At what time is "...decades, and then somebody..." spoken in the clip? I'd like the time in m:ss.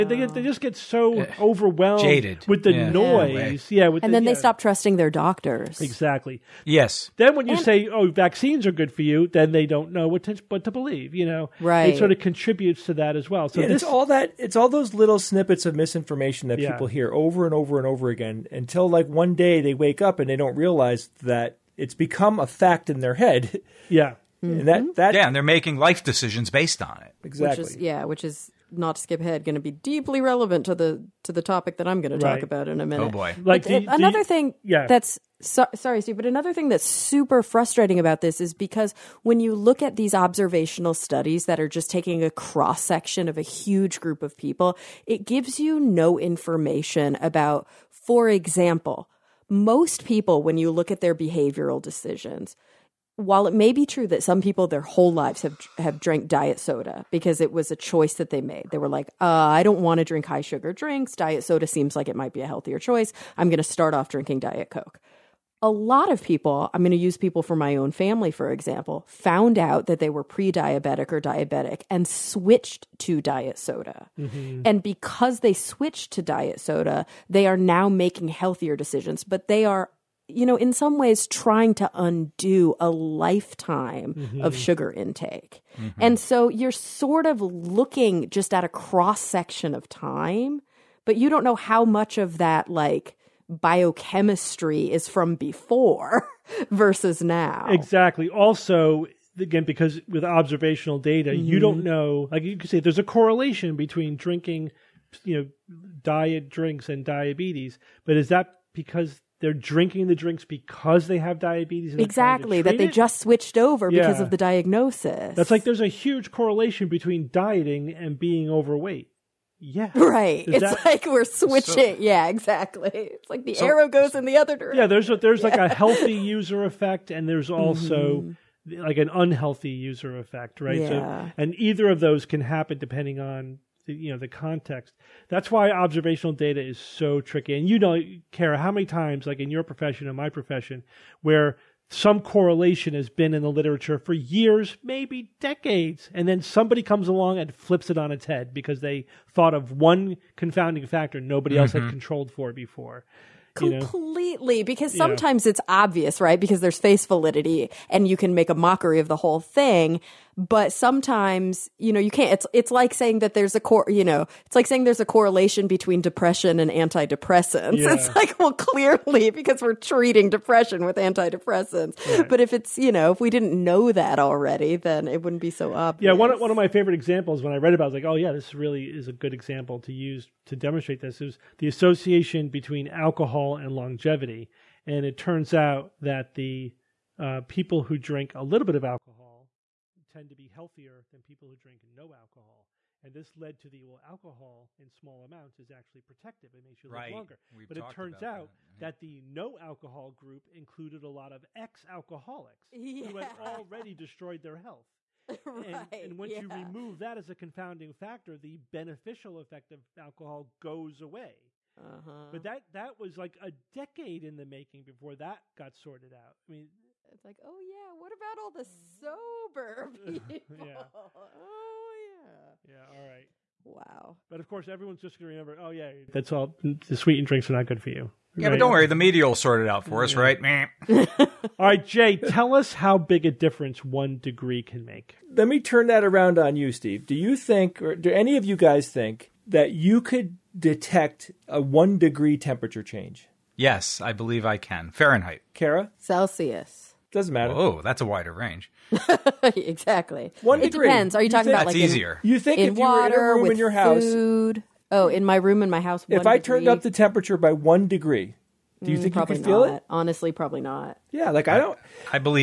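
2:25.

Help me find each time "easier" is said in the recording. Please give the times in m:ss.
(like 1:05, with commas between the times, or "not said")
4:11.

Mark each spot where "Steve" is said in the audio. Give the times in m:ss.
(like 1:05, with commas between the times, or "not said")
0:36, 3:56.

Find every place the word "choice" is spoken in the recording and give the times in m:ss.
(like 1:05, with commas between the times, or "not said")
0:57, 1:02.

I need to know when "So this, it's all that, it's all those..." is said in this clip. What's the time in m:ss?
0:13.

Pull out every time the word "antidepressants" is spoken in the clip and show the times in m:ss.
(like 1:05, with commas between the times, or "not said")
2:46, 2:50.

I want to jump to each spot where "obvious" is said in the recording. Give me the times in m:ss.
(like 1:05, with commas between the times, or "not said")
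2:35, 2:55.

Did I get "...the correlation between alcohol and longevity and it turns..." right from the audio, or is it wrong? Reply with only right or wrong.
wrong.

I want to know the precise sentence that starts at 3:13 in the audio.
And this led to the well, alcohol in small amounts is actually protective; it makes you live longer.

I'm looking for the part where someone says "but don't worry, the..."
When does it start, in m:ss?
3:48.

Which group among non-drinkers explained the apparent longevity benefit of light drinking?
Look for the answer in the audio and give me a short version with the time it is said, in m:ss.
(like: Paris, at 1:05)
ex-alcoholics, at 3:21.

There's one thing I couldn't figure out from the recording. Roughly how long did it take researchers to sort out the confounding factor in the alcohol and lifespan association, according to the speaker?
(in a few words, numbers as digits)
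a decade.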